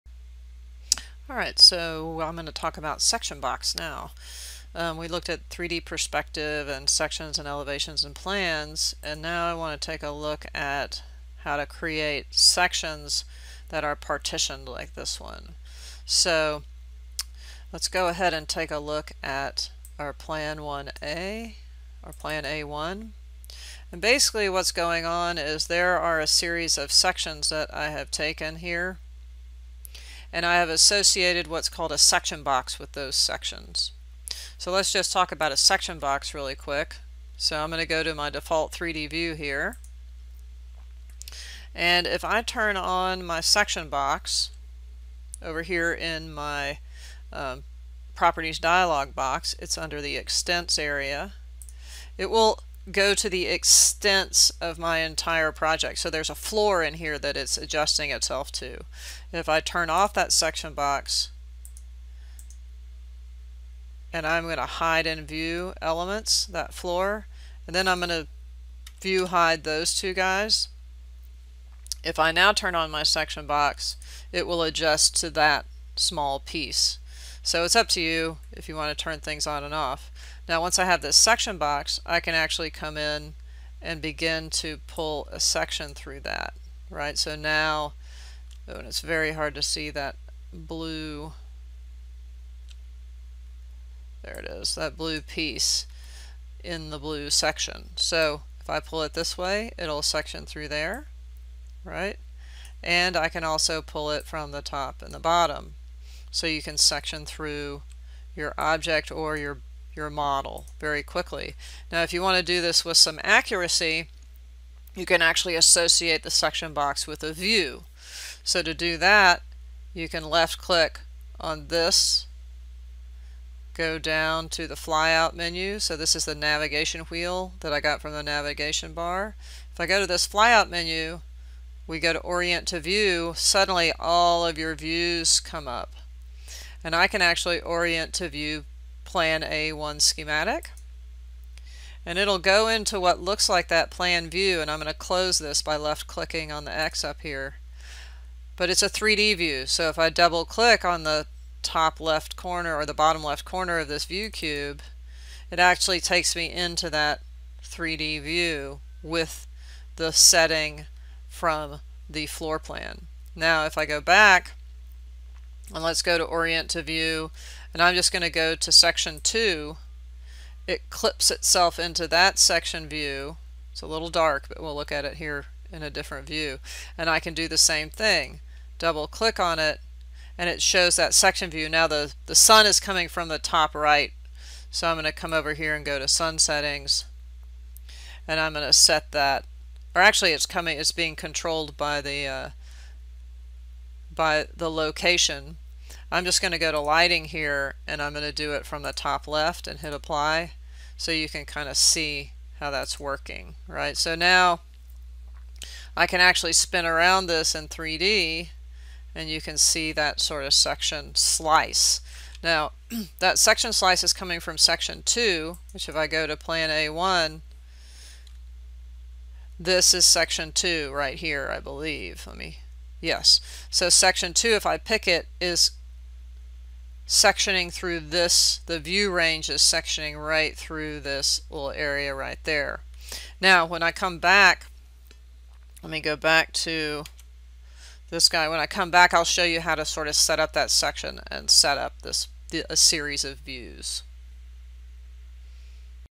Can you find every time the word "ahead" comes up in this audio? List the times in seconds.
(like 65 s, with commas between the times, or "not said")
18 s.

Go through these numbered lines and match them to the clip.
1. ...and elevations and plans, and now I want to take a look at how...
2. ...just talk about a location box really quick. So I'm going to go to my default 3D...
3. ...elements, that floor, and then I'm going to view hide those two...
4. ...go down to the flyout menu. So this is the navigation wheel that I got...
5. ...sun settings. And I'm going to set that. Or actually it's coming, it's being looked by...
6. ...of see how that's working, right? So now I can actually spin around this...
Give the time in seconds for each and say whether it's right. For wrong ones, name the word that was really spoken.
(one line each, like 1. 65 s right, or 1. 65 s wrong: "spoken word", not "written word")
1. 7 s right
2. 34 s wrong: "section", not "location"
3. 65 s right
4. 123 s right
5. 186 s wrong: "controlled", not "looked"
6. 201 s right.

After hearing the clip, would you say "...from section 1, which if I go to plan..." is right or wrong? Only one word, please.
wrong.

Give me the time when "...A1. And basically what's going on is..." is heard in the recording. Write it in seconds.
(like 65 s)
22 s.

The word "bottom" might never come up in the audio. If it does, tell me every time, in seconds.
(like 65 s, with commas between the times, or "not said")
105 s, 152 s.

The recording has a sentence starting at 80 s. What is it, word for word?
Now once I have this section box, I can actually come in and begin to pull a section through that, right?